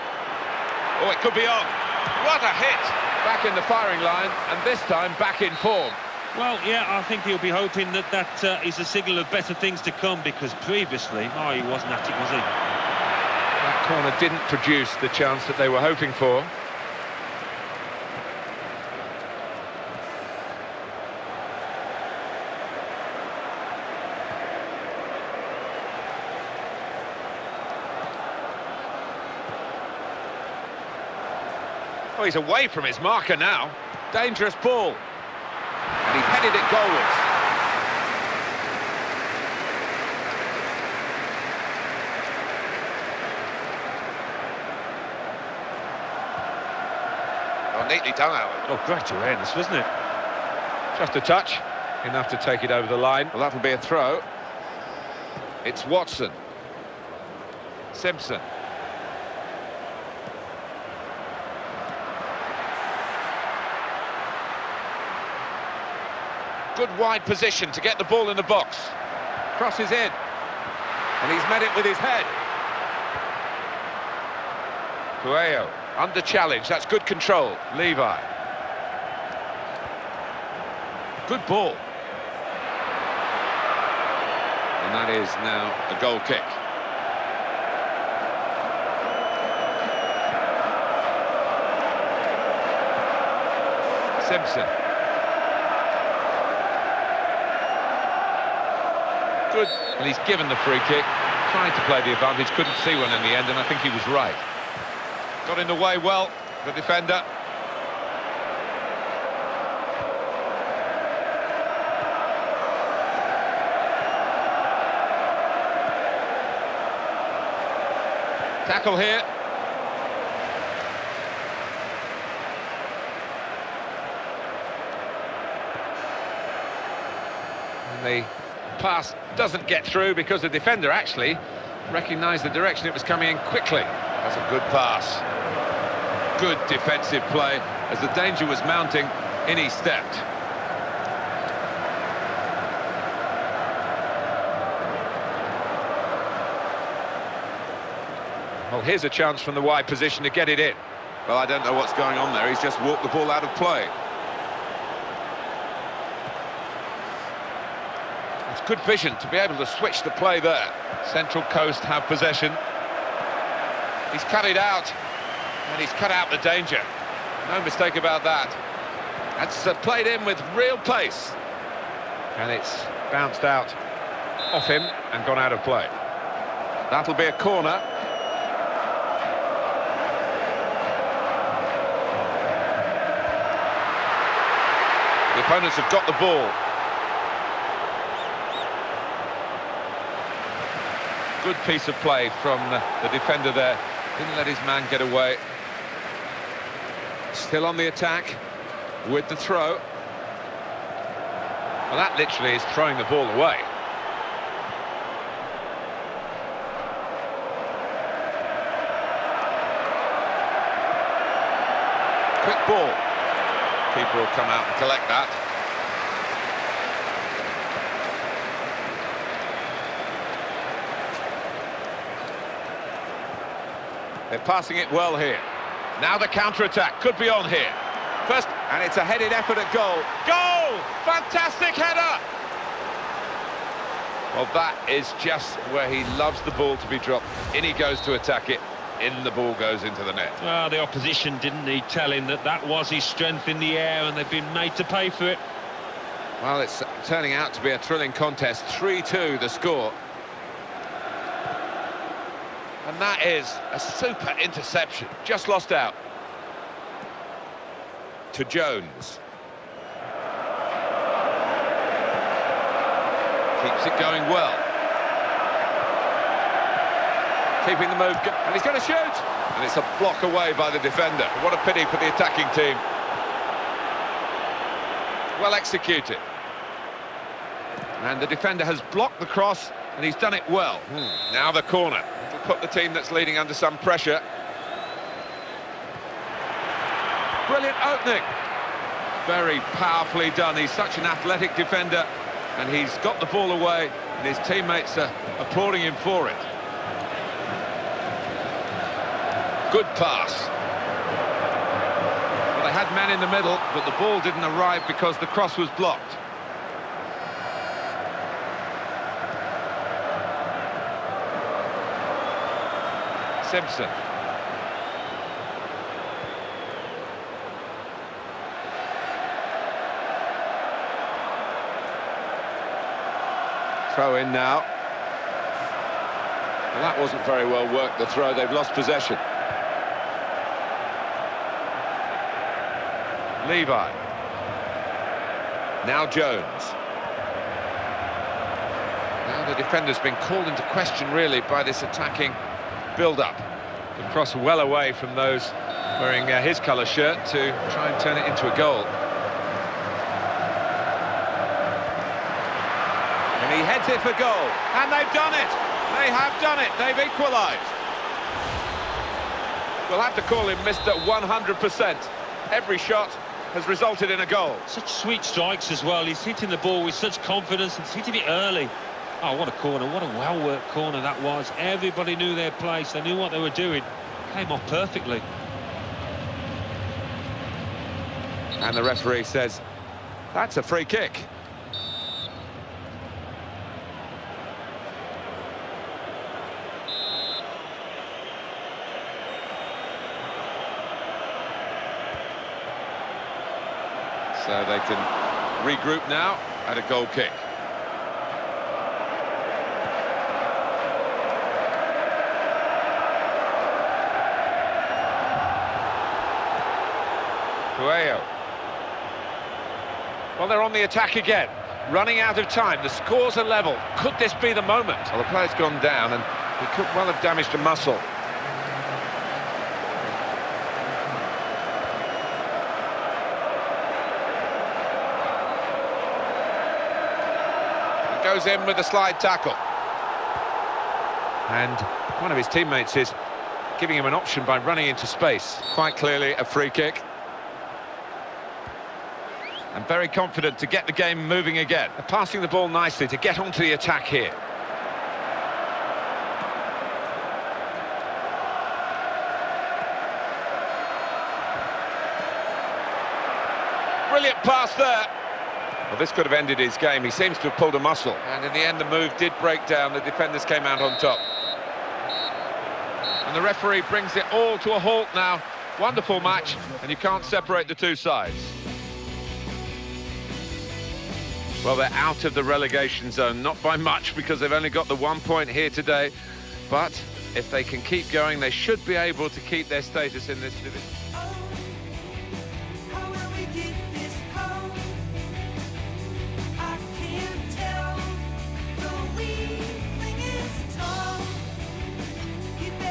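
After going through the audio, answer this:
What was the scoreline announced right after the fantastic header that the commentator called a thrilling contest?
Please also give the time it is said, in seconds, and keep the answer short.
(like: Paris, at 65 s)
3-2, at 248 s.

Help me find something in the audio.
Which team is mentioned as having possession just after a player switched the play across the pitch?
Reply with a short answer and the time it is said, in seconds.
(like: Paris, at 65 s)
Central Coast, at 161 s.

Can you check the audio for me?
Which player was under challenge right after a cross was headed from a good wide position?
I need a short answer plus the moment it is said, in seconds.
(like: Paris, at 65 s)
Cuello, at 75 s.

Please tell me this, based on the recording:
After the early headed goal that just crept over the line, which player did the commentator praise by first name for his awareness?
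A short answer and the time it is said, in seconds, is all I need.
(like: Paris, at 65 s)
Alan, at 48 s.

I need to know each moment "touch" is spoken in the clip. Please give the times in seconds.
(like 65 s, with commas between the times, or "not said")
51 s.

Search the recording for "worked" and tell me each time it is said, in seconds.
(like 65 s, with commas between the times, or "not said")
327 s, 370 s.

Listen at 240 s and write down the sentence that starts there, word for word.
Well, the opposition didn't need telling that that was his strength in the air and they've been made to pay for it.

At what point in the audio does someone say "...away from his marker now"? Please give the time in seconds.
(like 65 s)
32 s.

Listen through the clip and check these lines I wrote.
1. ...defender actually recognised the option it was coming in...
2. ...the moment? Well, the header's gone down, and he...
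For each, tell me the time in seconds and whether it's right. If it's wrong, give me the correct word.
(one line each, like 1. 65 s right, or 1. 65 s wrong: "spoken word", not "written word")
1. 130 s wrong: "direction", not "option"
2. 414 s wrong: "player", not "header".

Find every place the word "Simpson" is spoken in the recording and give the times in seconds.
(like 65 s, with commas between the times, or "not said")
57 s, 94 s, 313 s.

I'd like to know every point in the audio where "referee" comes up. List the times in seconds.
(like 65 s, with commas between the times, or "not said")
378 s, 463 s.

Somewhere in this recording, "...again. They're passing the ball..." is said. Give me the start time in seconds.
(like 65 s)
441 s.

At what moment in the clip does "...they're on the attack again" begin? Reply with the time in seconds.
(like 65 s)
410 s.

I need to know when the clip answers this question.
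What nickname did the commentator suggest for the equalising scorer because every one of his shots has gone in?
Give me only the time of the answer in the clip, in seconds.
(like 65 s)
360 s.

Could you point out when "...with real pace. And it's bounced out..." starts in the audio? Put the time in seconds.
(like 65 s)
170 s.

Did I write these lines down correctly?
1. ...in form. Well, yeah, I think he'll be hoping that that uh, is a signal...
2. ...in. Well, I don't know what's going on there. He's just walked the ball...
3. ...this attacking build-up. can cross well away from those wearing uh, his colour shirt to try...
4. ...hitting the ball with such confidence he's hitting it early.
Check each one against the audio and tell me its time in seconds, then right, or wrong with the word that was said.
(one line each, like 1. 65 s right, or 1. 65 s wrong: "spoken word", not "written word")
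1. 5 s right
2. 150 s right
3. 341 s right
4. 366 s right.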